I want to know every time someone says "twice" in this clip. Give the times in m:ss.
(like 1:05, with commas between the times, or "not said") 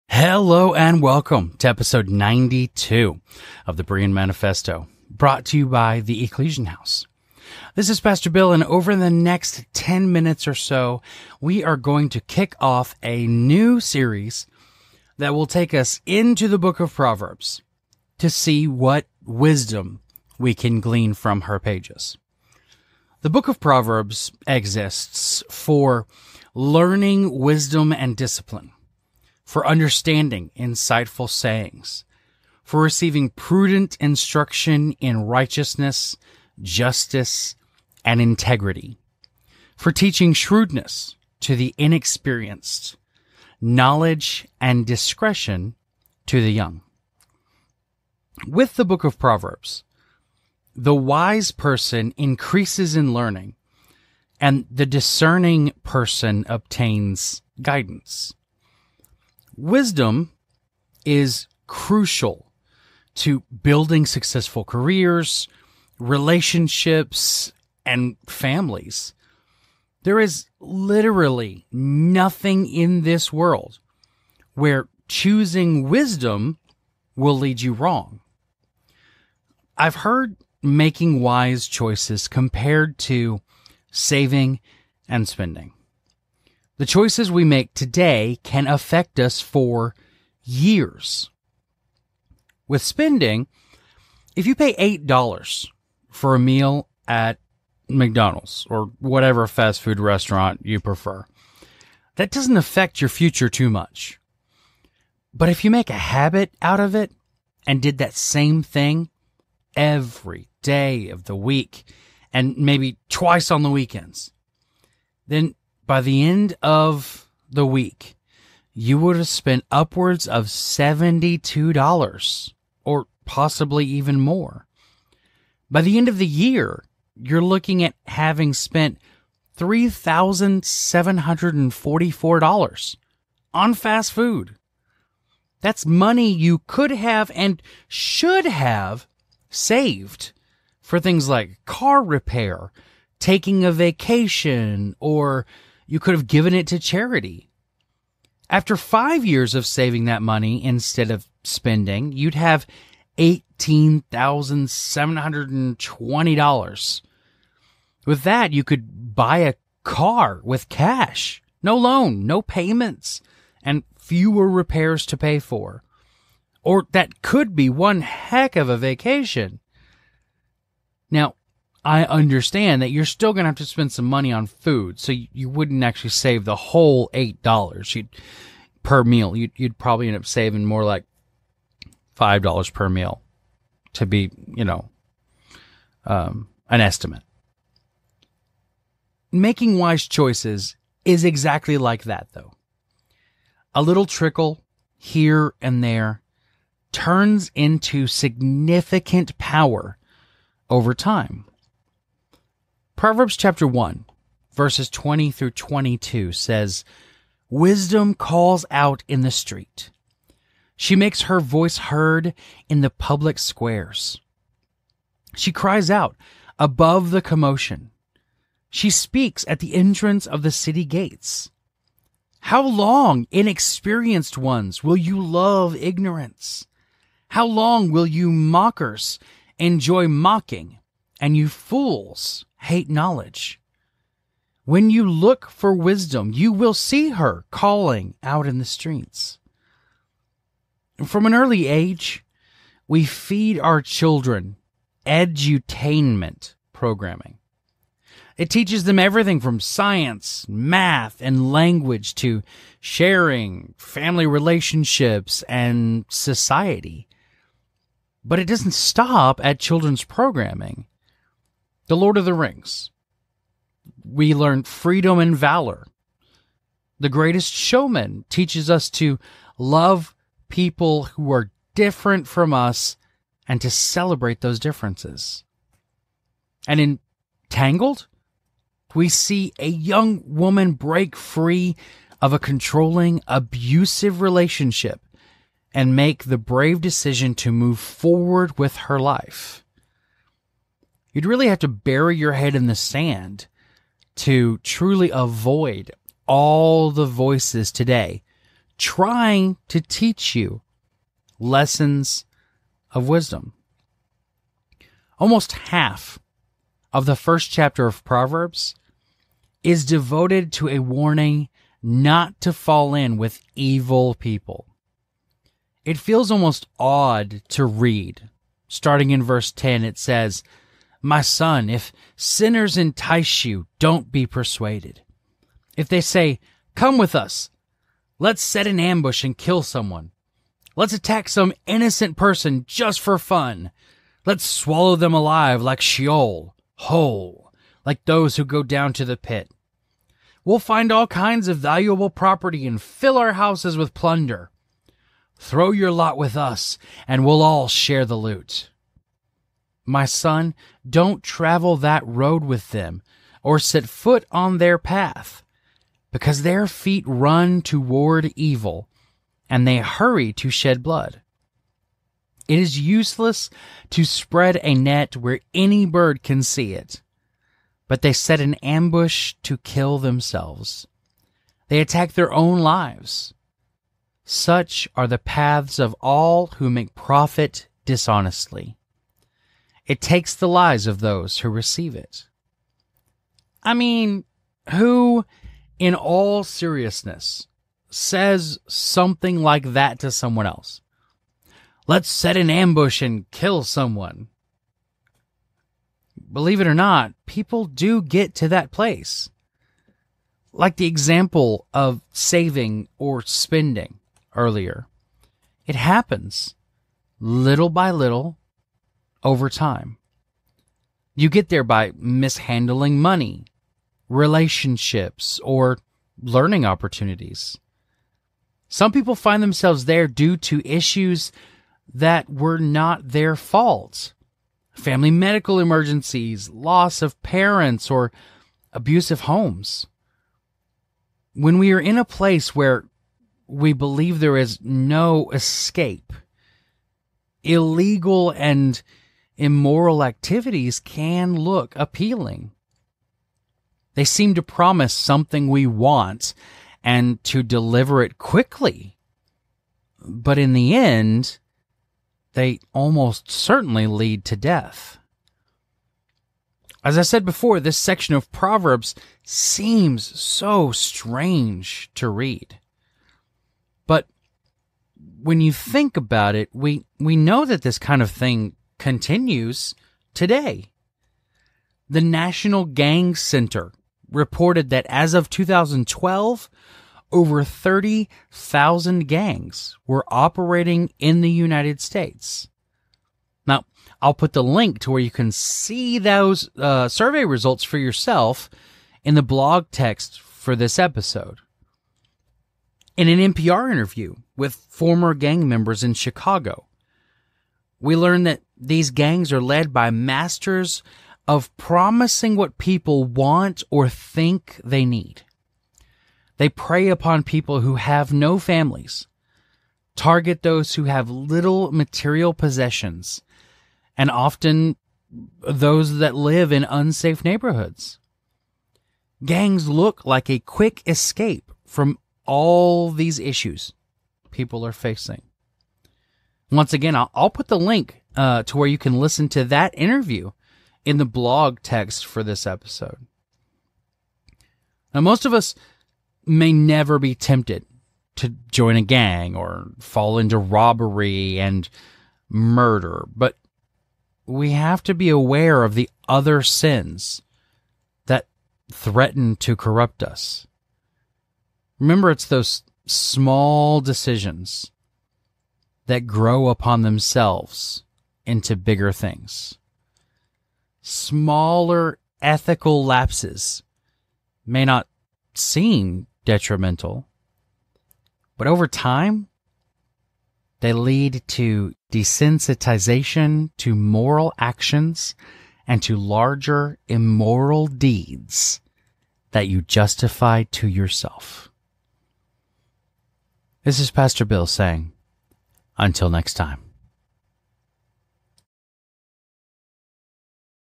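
1:53.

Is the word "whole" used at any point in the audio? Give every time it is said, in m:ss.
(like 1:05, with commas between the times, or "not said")
2:56, 5:36.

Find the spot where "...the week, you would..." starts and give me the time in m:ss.
1:57.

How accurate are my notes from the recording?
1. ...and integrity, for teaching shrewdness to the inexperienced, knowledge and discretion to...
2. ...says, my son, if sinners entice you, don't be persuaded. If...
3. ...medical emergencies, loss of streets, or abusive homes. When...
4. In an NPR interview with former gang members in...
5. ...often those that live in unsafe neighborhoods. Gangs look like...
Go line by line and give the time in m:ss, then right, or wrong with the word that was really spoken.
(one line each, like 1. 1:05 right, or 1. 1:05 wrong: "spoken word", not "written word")
1. 0:38 right
2. 5:19 right
3. 7:05 wrong: "parents", not "streets"
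4. 8:12 right
5. 8:34 right.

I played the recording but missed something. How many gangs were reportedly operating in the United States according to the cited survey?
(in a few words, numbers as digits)
over 30,000.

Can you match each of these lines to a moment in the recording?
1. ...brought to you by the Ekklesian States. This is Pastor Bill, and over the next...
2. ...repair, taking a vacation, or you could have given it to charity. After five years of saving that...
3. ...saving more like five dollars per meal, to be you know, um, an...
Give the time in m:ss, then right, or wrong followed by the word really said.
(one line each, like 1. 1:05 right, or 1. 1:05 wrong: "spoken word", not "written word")
1. 0:05 wrong: "House", not "States"
2. 2:22 right
3. 3:00 right.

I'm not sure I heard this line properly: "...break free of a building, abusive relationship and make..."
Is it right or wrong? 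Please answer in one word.
wrong.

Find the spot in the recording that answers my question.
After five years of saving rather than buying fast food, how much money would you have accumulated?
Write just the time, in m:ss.
2:33.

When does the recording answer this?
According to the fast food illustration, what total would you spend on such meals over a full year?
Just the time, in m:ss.
2:09.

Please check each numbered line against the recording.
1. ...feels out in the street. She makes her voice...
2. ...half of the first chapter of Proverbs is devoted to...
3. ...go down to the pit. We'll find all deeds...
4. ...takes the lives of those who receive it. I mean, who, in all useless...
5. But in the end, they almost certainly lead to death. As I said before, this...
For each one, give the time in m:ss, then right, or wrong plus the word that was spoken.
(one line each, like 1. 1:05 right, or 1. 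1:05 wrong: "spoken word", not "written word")
1. 3:28 wrong: "calls", not "feels"
2. 5:05 right
3. 5:38 wrong: "kinds", not "deeds"
4. 6:20 wrong: "seriousness", not "useless"
5. 7:29 right.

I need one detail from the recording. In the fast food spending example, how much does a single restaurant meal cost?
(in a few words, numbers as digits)
$8.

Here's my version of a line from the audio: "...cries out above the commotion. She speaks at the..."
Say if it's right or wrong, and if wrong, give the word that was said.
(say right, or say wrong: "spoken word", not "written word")
right.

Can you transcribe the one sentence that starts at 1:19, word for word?
I've heard making wise choices compared to saving and spending.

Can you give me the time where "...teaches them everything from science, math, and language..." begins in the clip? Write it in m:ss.
4:08.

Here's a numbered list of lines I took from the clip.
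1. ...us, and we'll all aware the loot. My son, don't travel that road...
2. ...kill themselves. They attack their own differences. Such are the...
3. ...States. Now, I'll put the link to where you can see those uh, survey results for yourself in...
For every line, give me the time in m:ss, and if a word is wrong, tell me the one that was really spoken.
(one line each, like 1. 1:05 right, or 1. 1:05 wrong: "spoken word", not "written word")
1. 5:46 wrong: "share", not "aware"
2. 6:09 wrong: "lives", not "differences"
3. 8:01 right.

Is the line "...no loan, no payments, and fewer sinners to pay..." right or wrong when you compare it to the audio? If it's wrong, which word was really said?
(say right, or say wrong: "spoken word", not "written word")
wrong: "repairs", not "sinners".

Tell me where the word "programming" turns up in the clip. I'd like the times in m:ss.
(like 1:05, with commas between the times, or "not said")
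4:06, 4:20.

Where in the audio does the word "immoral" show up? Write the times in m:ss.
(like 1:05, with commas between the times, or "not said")
7:19, 9:36.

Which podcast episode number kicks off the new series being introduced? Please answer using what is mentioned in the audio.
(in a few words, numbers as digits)
92.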